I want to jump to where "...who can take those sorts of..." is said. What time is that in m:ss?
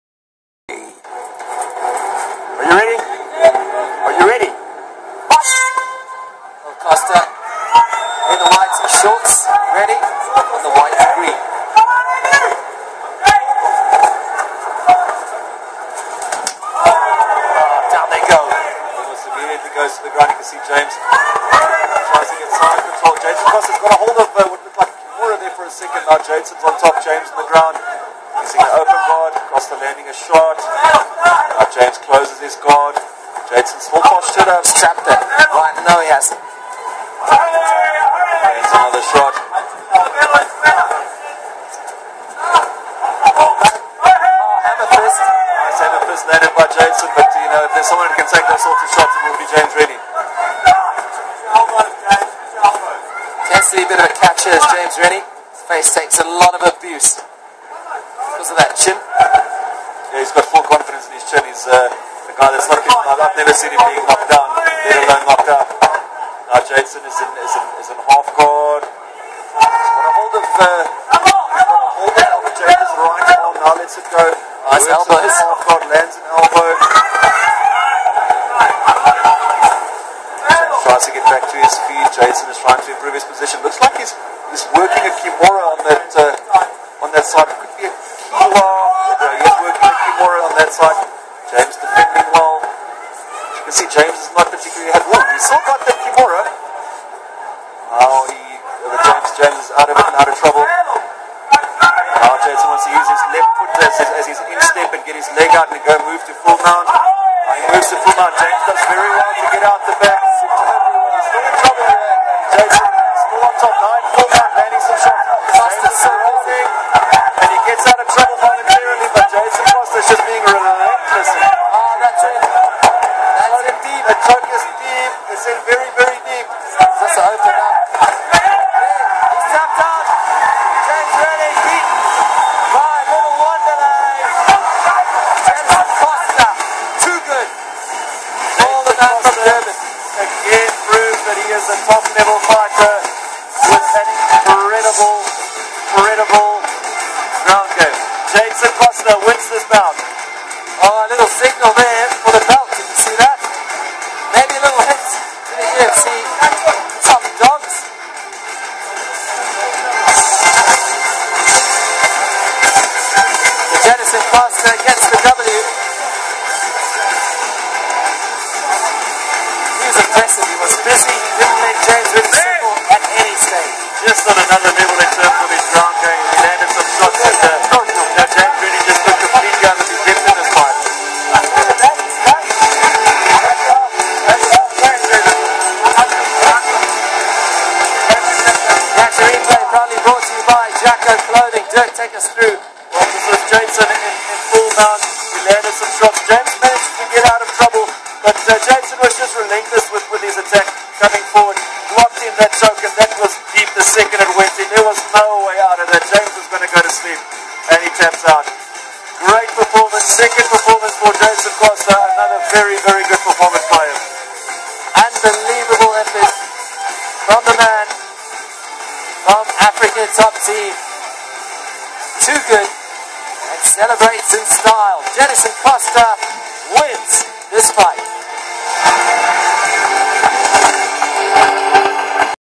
0:48.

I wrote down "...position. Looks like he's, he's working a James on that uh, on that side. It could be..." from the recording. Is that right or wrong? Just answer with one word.
wrong.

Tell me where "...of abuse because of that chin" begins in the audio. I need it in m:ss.
0:56.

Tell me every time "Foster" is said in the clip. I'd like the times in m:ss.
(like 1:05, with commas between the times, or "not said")
1:55, 1:59.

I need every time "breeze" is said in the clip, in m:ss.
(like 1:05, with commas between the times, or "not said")
not said.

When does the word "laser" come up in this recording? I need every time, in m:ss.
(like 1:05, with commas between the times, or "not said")
not said.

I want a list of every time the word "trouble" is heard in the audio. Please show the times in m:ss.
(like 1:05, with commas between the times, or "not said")
1:40, 1:51, 1:58, 3:17.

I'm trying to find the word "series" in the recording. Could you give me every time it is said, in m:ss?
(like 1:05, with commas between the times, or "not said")
not said.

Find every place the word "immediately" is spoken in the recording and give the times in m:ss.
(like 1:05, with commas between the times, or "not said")
0:19.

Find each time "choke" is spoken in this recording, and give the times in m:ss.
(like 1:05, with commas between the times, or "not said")
2:04, 3:22.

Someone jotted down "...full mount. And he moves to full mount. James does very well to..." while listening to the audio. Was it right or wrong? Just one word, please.
right.